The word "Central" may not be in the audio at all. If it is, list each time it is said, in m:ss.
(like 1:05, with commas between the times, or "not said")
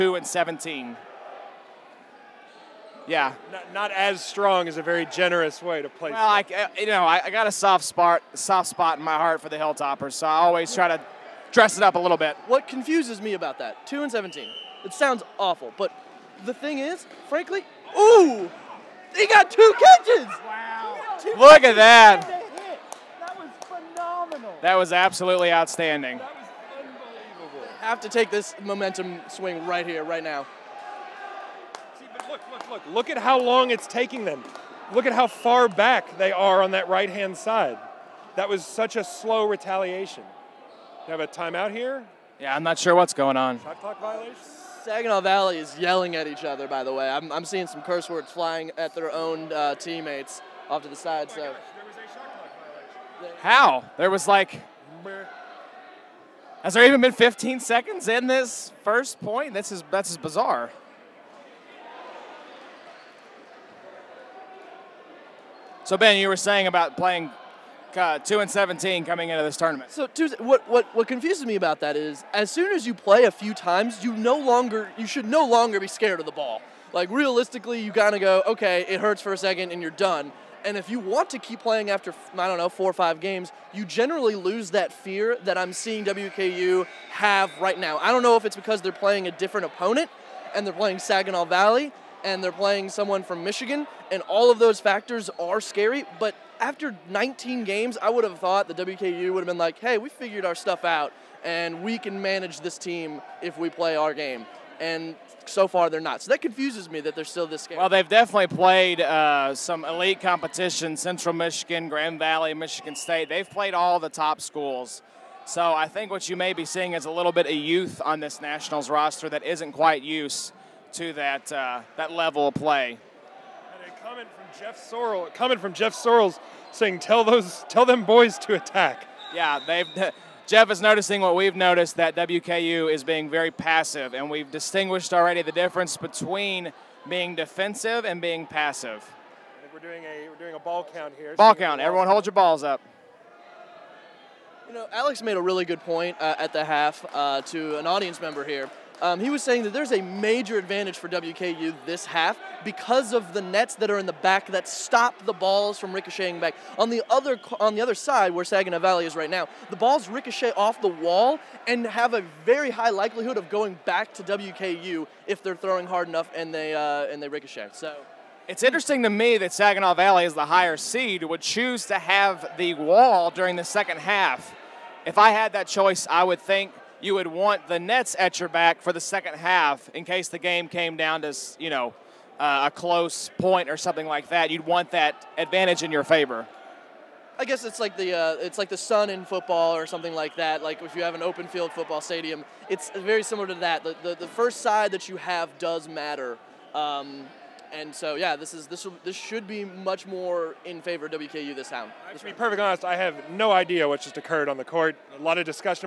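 1:50.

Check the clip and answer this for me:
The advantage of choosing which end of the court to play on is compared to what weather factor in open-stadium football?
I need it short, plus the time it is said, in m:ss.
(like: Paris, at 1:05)
the sun, at 3:08.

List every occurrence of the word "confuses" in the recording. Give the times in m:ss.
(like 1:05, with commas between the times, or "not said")
0:12, 1:11, 1:46.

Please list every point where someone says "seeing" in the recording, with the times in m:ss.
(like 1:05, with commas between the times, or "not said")
0:47, 1:25, 1:56.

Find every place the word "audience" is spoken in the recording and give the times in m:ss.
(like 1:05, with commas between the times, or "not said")
2:27.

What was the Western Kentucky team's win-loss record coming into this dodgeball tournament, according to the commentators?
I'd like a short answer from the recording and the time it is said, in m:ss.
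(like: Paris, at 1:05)
2-17, at 1:08.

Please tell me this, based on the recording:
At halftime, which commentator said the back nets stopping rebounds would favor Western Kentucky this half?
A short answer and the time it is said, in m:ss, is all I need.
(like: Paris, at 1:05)
Alex, at 2:24.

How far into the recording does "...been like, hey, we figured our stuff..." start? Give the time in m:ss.
1:39.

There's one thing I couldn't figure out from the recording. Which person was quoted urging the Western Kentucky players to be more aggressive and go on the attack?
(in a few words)
Jeff Sorrells.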